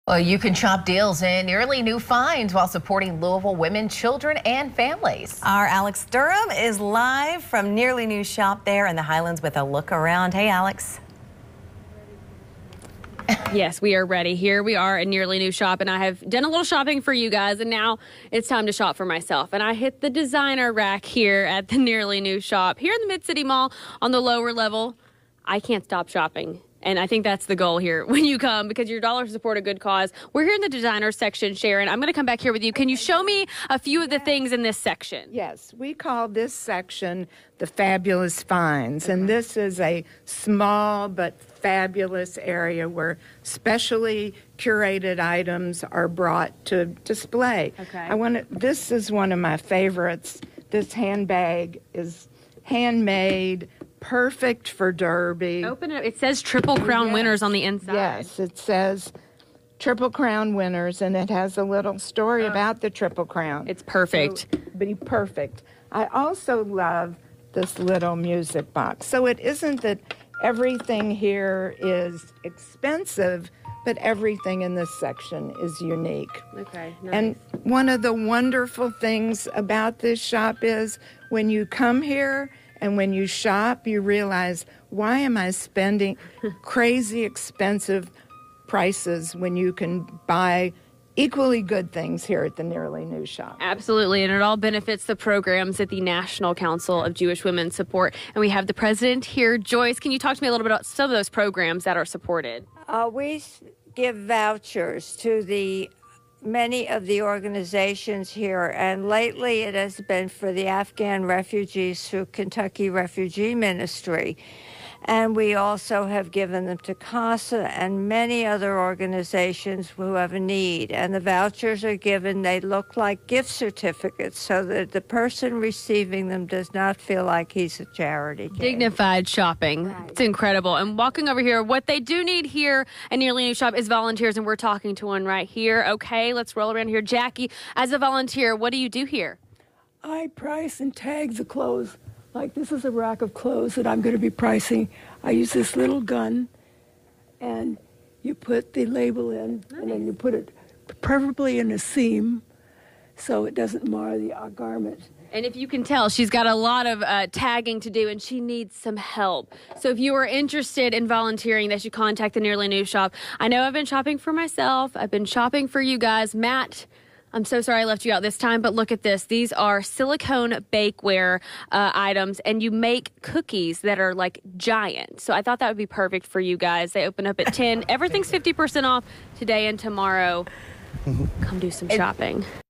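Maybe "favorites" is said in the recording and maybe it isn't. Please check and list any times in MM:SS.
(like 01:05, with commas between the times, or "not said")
00:49.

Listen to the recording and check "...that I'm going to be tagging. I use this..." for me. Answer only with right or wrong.
wrong.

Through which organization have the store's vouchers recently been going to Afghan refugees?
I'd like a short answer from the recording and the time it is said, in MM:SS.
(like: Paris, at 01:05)
Kentucky Refugee Ministry, at 01:52.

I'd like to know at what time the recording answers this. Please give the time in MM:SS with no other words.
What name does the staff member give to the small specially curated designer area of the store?
00:37.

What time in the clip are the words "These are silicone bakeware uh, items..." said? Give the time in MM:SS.
02:49.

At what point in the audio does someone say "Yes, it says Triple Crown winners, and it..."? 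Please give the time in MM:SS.
00:57.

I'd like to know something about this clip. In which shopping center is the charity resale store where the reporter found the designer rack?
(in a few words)
Mid City Mall.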